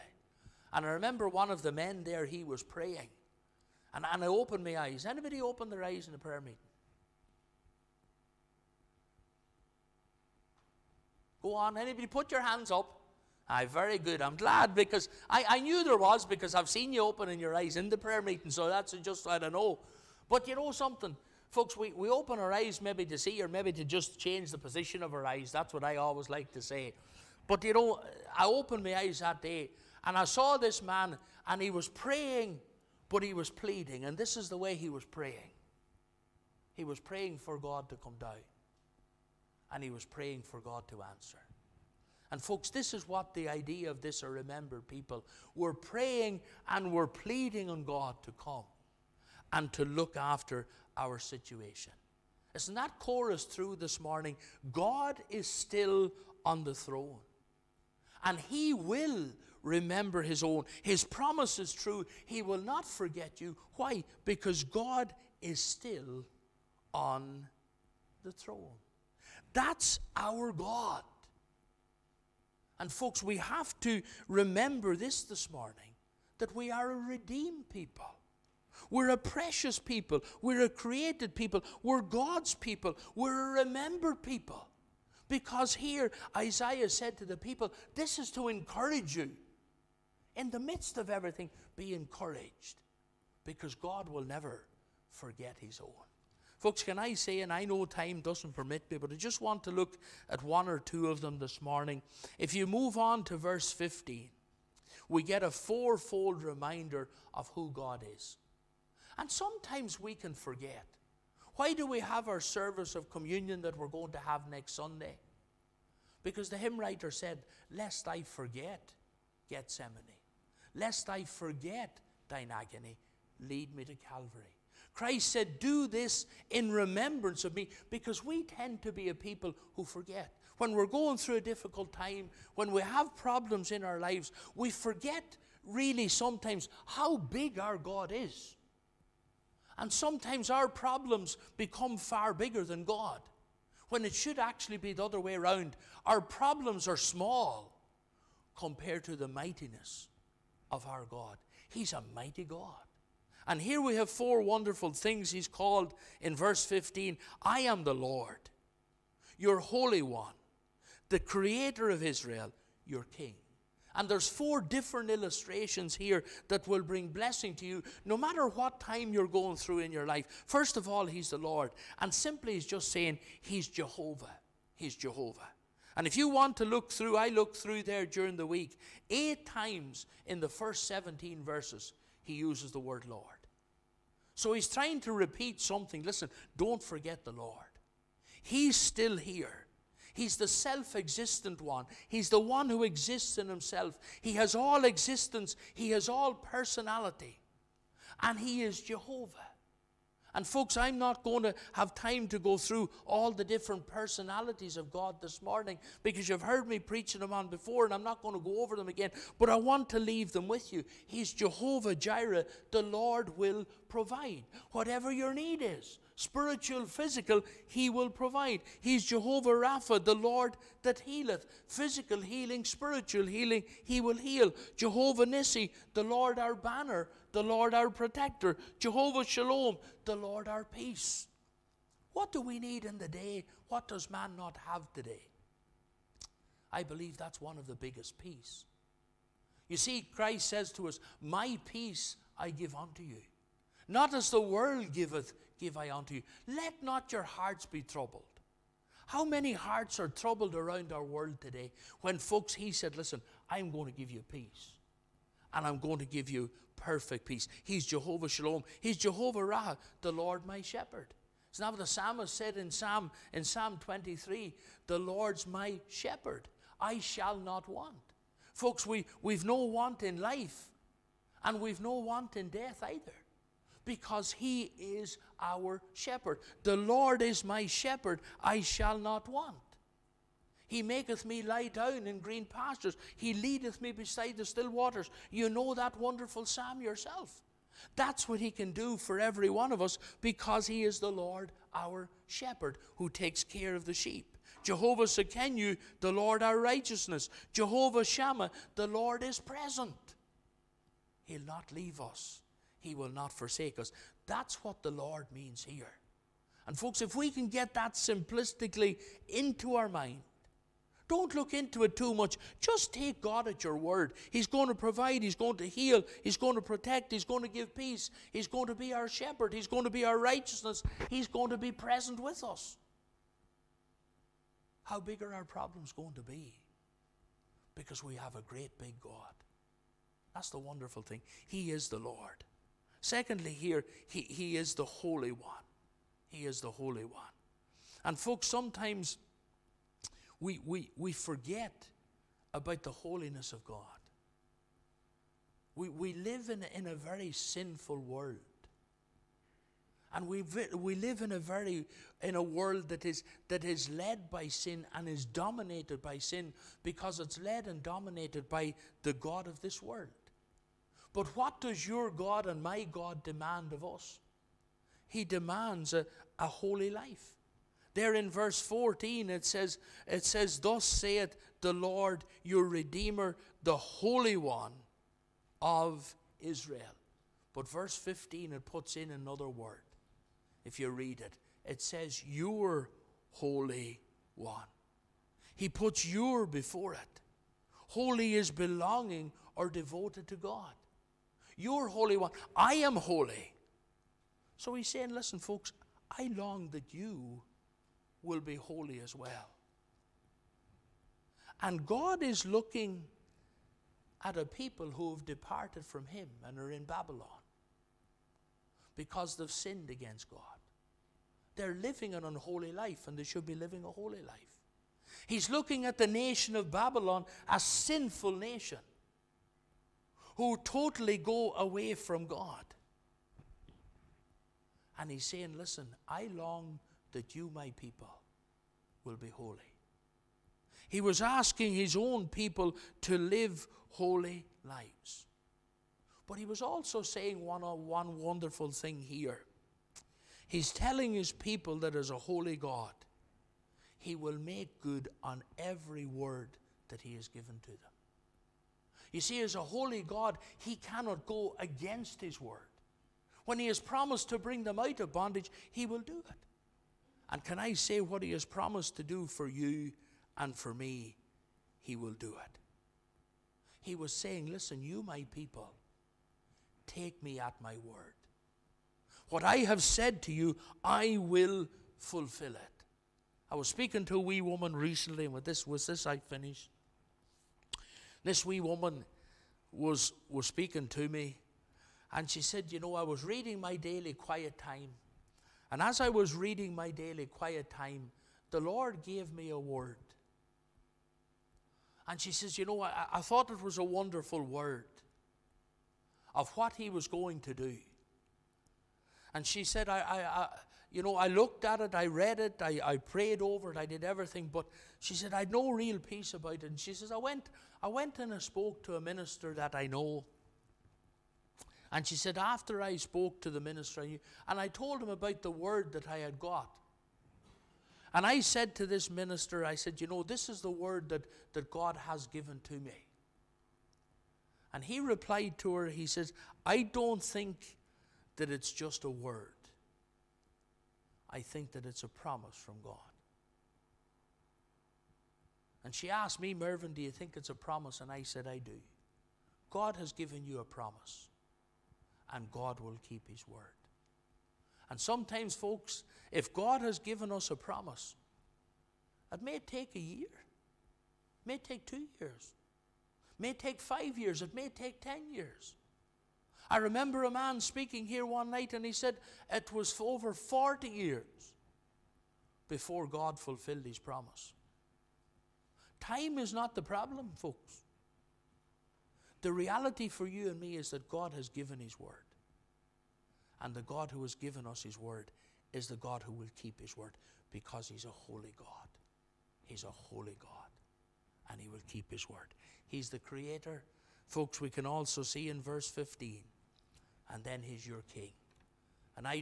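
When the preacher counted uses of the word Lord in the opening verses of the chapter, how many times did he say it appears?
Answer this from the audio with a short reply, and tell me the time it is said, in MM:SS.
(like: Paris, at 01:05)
8, at 02:59.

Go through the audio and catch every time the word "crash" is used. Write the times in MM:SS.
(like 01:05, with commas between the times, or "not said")
not said.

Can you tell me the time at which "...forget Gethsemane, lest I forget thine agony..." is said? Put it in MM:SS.
01:58.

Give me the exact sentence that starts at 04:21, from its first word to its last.
It's not what the psalmist said in Psalm, in Psalm 23 The Lord's my shepherd.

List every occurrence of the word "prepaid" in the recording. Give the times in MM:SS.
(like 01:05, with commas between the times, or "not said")
not said.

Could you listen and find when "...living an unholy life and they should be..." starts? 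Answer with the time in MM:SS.
06:51.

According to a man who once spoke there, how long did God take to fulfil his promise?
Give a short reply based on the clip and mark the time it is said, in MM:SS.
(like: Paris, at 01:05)
Over 40 years, at 09:19.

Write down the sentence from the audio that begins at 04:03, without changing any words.
Not as the world giveth, give I unto you.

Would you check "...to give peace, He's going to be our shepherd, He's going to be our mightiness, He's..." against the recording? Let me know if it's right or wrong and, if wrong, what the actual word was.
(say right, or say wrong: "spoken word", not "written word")
wrong: "righteousness", not "mightiness".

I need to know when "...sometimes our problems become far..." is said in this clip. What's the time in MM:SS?
02:19.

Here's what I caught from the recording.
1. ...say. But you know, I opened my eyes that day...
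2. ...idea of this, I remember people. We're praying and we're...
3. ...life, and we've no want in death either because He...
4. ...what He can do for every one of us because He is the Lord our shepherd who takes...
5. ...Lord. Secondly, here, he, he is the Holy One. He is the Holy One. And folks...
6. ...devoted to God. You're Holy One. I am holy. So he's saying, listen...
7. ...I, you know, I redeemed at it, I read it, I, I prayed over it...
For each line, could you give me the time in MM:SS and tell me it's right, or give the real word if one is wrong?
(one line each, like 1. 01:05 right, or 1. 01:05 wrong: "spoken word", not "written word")
1. 00:26 right
2. 00:43 right
3. 04:30 right
4. 04:48 right
5. 05:31 right
6. 06:29 right
7. 08:19 wrong: "looked", not "redeemed".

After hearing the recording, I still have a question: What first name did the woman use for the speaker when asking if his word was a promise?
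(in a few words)
Mervyn.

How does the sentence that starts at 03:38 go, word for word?
He's Jehovah Rapha, the Lord that healeth.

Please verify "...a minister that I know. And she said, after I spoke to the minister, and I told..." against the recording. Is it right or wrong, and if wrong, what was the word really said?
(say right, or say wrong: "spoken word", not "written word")
right.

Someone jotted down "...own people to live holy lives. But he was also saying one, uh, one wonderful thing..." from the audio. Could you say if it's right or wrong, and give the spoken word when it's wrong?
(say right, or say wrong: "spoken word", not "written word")
right.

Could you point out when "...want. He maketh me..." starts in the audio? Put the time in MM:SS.
04:39.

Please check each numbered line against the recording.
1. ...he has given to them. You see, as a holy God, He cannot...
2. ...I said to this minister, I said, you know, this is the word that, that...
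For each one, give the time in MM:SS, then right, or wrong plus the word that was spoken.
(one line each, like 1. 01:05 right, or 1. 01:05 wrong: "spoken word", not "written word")
1. 07:27 right
2. 08:38 right.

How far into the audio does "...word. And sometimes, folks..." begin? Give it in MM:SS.
09:03.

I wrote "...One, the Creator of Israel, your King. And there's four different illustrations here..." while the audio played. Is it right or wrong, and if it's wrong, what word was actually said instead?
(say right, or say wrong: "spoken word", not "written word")
right.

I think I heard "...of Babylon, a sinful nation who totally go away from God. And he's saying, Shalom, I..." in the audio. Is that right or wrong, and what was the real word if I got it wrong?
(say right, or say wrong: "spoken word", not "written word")
wrong: "Listen", not "Shalom".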